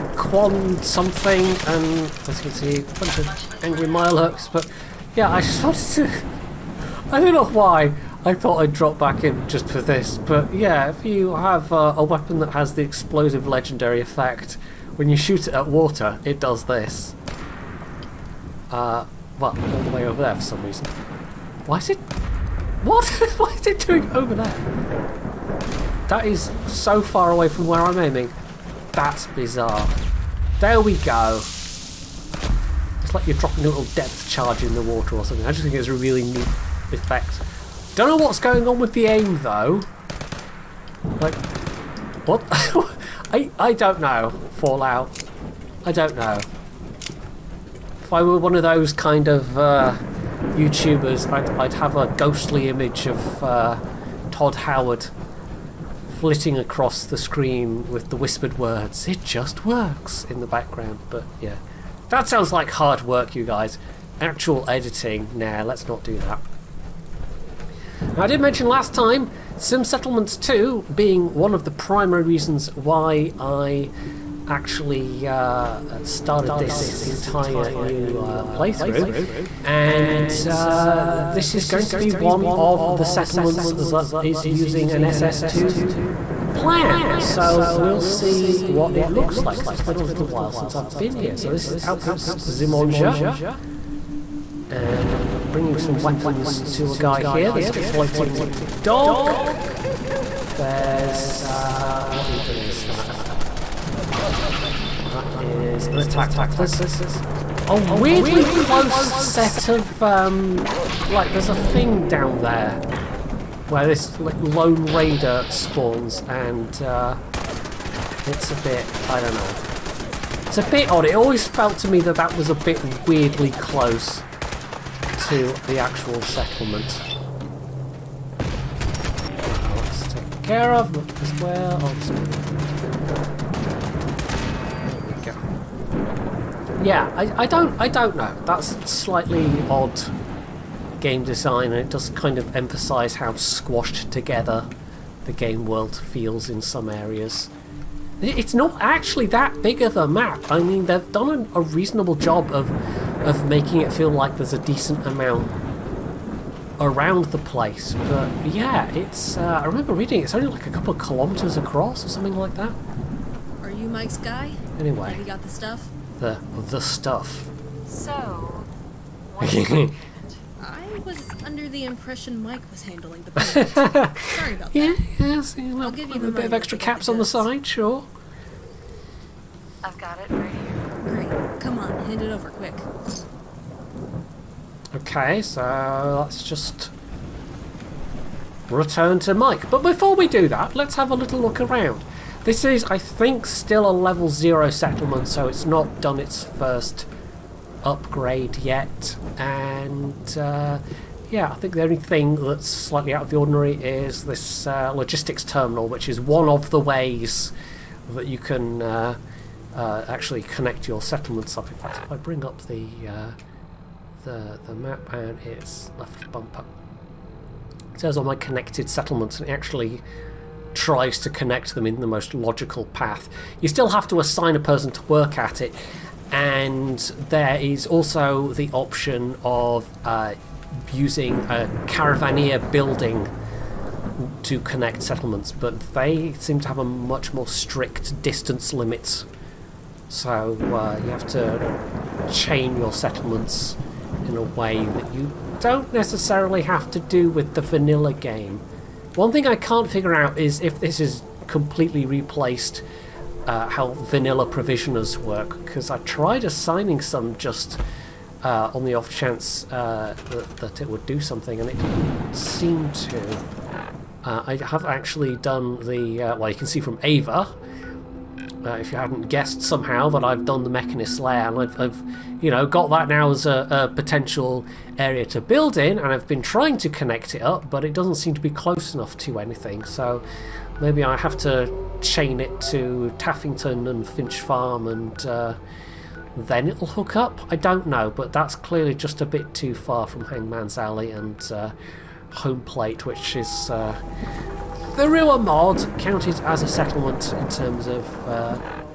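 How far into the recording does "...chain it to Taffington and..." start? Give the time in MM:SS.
04:42.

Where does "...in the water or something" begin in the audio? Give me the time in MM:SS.
00:34.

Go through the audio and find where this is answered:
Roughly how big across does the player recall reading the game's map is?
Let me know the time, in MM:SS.
02:40.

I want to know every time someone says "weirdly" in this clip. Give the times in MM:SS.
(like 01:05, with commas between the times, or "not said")
01:47, 02:03.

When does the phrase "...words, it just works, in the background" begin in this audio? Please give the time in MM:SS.
00:58.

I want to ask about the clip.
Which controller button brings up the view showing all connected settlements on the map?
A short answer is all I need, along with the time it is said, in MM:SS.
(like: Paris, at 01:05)
left bumper, at 03:35.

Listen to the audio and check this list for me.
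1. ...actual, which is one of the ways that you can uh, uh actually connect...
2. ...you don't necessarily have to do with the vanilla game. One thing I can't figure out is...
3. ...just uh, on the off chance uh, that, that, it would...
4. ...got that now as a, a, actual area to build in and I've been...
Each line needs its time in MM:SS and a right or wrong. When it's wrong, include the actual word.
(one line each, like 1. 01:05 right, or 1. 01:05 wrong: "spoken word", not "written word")
1. 03:25 wrong: "terminal", not "actual"
2. 04:05 right
3. 04:17 right
4. 04:32 wrong: "potential", not "actual".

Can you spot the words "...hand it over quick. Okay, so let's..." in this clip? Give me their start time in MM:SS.
03:02.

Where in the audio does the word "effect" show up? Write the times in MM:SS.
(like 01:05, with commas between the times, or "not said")
00:14, 00:36.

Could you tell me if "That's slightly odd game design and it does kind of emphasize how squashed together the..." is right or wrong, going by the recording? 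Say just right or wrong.
right.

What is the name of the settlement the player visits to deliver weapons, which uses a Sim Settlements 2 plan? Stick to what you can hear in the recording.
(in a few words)
Outpost Zimonja.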